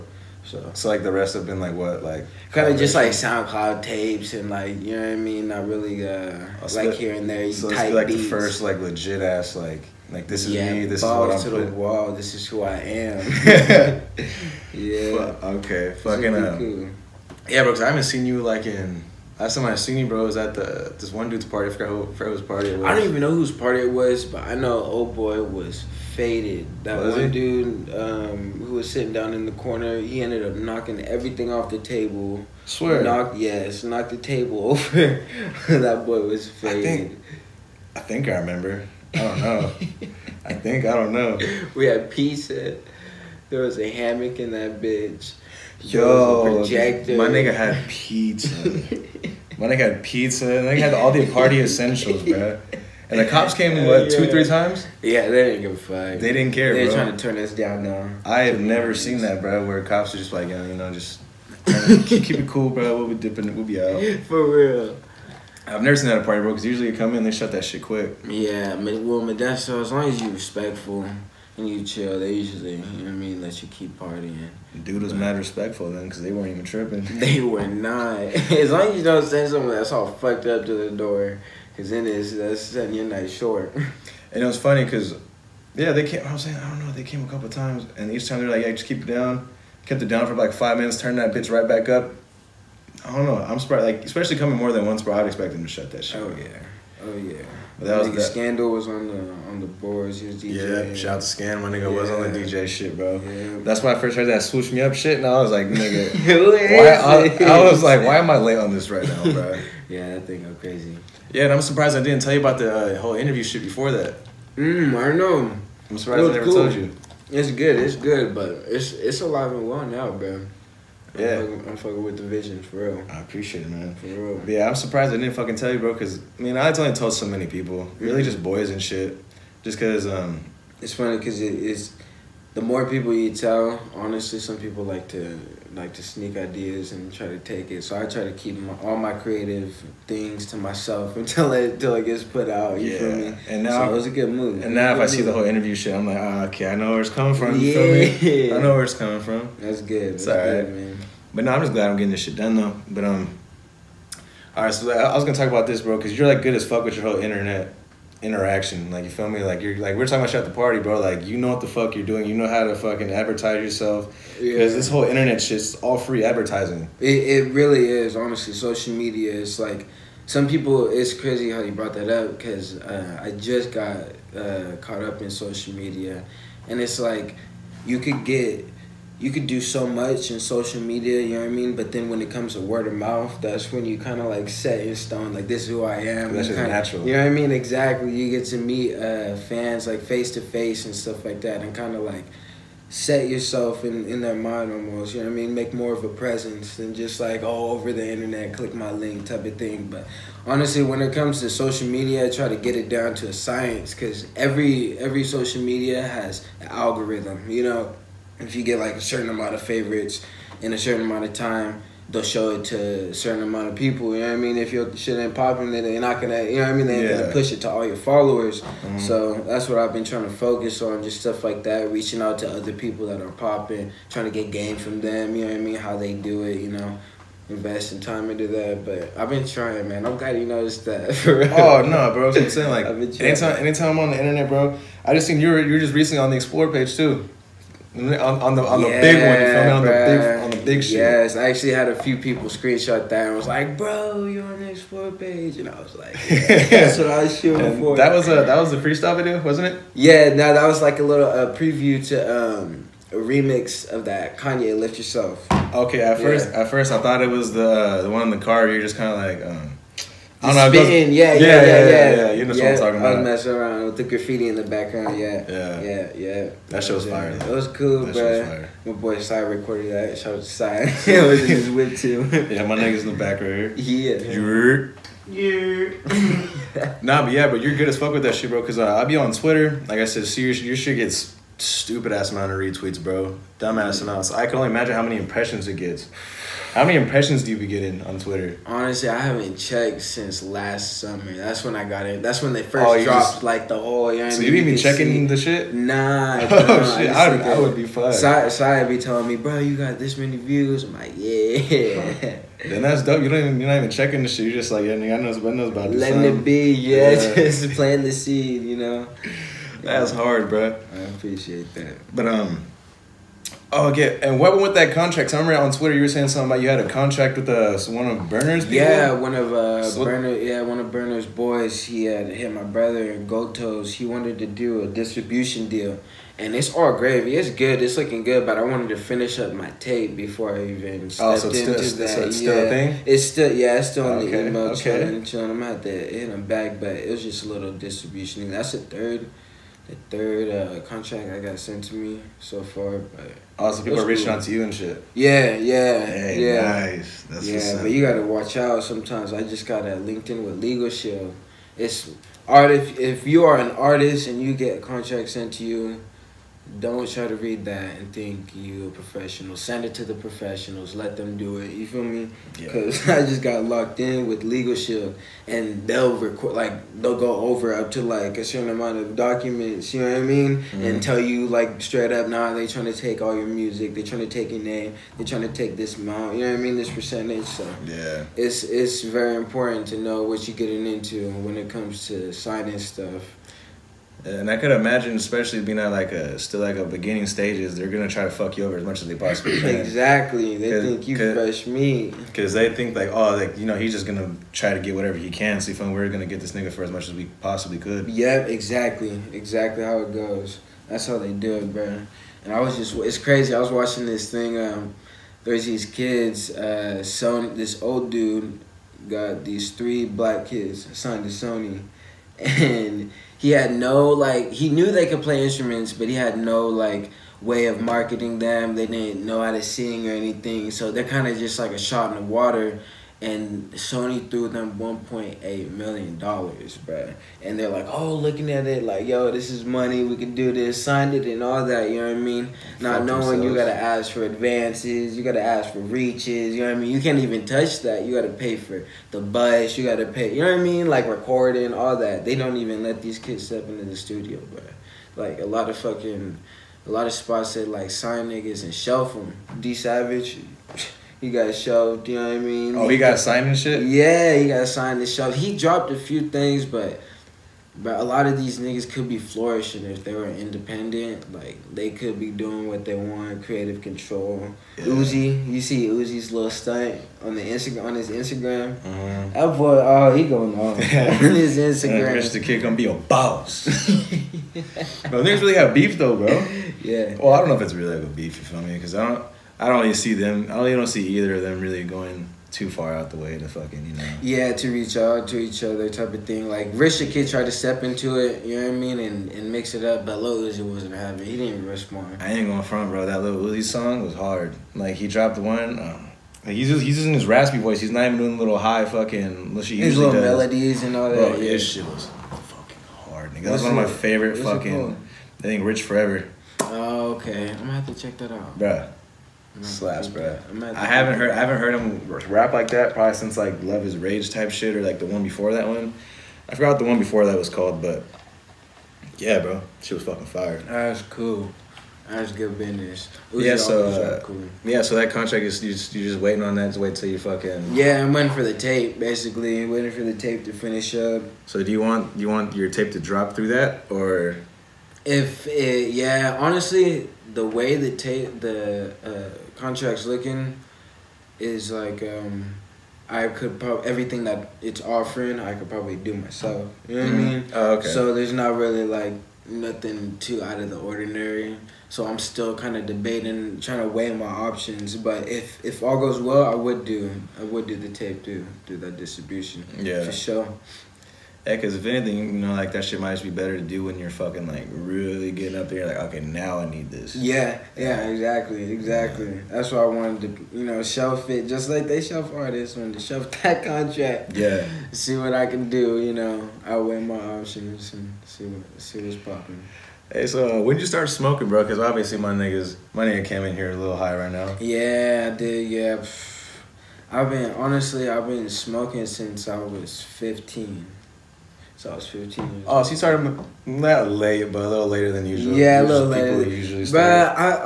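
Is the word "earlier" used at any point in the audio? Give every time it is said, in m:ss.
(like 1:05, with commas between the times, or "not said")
not said.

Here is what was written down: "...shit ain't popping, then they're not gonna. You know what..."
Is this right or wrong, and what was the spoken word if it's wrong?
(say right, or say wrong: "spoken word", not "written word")
right.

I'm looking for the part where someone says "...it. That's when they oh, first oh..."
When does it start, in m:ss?
4:52.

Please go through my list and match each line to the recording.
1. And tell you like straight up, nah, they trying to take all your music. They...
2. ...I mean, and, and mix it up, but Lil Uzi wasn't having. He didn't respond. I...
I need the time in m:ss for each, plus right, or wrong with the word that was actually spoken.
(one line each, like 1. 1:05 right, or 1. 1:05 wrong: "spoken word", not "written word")
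1. 6:10 right
2. 8:08 right.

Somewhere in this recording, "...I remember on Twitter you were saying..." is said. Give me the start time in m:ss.
5:15.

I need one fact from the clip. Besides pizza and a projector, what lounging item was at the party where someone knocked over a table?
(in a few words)
Hammock.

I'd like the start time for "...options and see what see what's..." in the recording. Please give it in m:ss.
9:37.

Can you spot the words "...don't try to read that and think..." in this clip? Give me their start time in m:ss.
5:56.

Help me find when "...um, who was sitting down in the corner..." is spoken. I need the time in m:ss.
0:27.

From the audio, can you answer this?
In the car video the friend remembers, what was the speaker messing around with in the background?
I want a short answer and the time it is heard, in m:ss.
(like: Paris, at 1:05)
Graffiti, at 4:24.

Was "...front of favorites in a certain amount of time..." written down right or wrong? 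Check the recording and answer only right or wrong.
wrong.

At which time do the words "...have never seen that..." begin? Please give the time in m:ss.
0:58.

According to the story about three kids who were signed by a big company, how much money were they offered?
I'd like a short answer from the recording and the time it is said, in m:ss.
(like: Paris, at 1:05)
$1.8 million, at 7:04.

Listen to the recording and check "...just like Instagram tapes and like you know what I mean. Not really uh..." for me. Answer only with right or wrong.
wrong.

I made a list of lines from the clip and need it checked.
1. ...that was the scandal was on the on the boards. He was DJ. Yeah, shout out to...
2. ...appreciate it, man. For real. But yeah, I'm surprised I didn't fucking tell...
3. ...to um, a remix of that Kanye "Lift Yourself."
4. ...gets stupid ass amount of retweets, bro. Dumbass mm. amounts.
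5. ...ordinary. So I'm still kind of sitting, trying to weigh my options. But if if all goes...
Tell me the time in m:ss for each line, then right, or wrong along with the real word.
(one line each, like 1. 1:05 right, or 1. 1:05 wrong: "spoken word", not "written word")
1. 1:37 right
2. 2:03 right
3. 4:12 right
4. 4:40 right
5. 9:10 wrong: "debating", not "sitting".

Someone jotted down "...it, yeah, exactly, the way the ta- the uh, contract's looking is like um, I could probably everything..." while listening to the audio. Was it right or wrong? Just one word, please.
wrong.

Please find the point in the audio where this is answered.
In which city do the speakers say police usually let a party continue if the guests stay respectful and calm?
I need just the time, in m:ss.
1:09.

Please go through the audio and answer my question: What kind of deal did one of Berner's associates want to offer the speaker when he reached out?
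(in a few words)
Distribution deal.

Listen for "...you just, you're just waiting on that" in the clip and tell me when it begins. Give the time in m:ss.
8:45.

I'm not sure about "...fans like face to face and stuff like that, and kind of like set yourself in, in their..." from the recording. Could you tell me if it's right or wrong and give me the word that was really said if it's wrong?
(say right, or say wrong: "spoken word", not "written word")
right.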